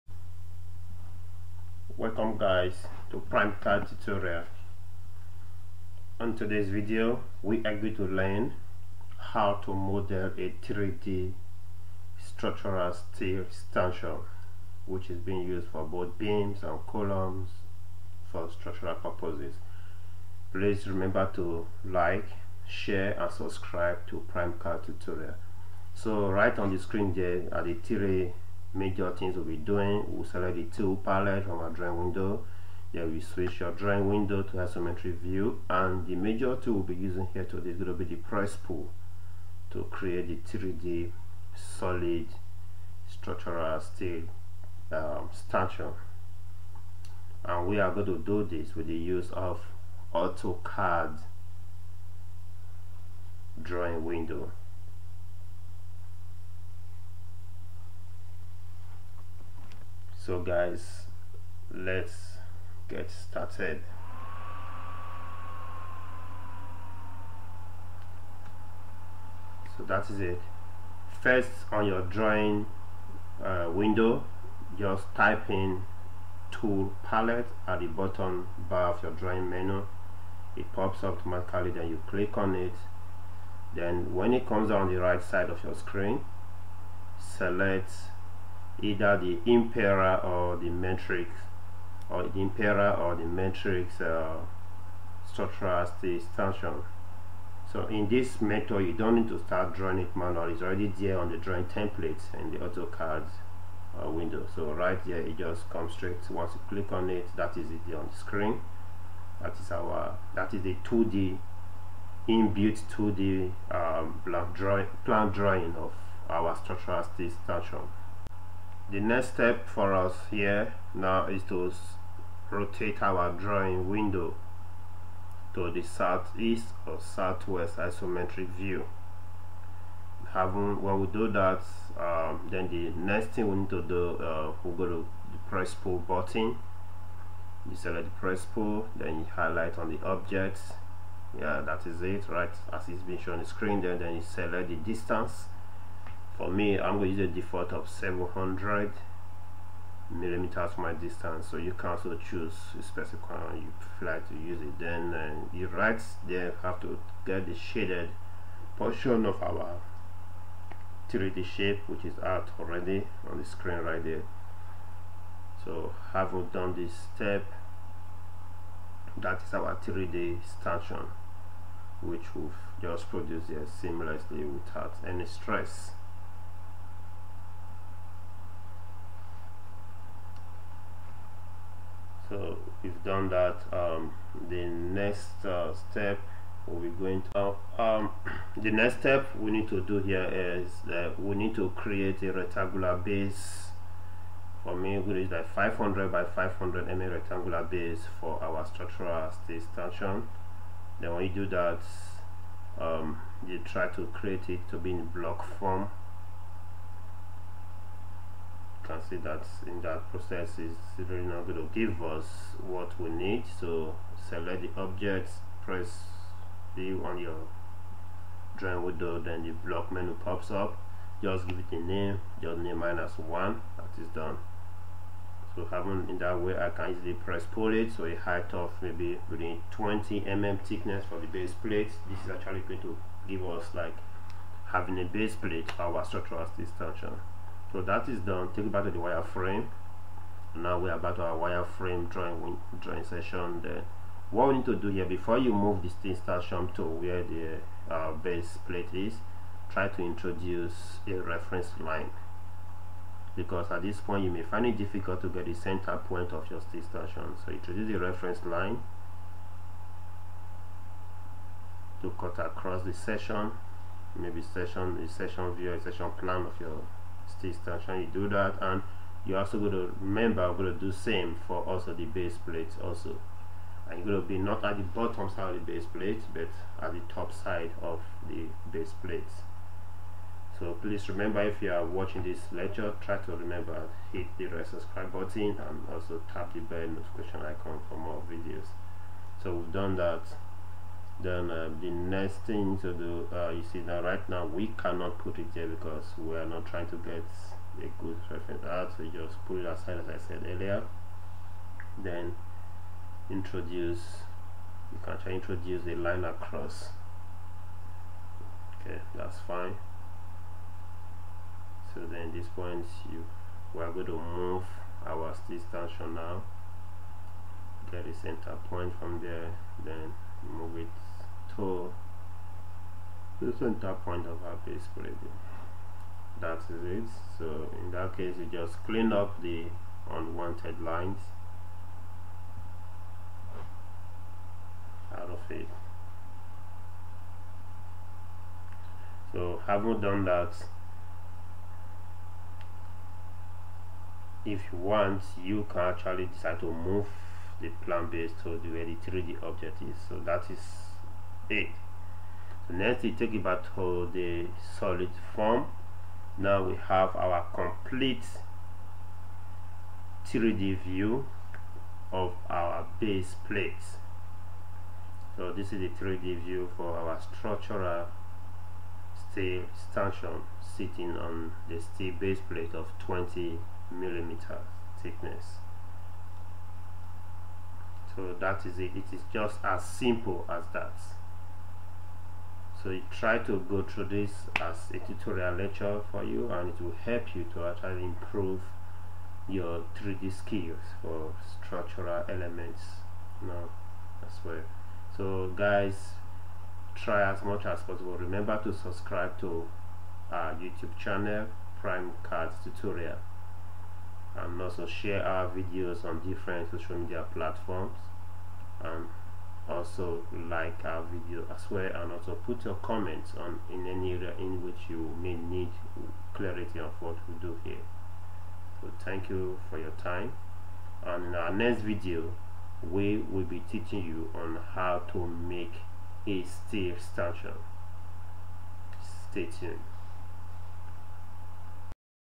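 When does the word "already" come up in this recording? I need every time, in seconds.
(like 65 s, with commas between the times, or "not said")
100 s, 162 s.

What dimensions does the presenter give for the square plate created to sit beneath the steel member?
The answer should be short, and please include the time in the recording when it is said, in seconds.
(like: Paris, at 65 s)
500 by 500 mm, at 195 s.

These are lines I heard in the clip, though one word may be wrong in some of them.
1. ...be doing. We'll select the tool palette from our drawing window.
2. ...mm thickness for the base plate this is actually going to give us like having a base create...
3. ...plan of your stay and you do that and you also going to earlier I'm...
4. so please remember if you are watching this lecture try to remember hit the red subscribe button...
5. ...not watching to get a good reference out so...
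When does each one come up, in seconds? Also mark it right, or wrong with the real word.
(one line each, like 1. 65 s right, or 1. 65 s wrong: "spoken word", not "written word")
1. 29 s right
2. 230 s wrong: "plate", not "create"
3. 266 s wrong: "remember", not "earlier"
4. 280 s right
5. 296 s wrong: "trying", not "watching".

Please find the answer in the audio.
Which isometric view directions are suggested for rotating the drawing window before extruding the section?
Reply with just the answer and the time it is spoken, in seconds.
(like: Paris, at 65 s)
southeast or southwest, at 125 s.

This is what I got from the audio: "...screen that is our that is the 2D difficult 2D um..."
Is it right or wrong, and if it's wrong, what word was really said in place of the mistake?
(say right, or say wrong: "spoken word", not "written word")
wrong: "inbuilt", not "difficult".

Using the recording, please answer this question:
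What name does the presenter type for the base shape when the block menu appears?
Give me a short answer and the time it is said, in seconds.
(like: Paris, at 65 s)
minus one, at 222 s.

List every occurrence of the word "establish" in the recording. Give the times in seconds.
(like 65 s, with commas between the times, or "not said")
not said.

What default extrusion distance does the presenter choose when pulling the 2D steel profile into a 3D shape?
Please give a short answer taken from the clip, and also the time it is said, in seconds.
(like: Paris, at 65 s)
700 mm, at 147 s.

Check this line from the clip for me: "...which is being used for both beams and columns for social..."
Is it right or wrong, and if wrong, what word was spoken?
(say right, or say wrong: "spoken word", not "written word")
wrong: "structural", not "social".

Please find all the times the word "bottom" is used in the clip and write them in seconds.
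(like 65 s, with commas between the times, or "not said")
77 s, 274 s.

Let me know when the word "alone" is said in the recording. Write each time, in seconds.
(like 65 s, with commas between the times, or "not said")
not said.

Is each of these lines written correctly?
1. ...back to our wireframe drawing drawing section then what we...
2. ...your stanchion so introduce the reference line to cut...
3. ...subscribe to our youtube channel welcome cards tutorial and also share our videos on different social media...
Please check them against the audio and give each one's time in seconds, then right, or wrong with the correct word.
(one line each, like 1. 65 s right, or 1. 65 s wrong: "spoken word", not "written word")
1. 240 s right
2. 256 s right
3. 398 s wrong: "prime", not "welcome".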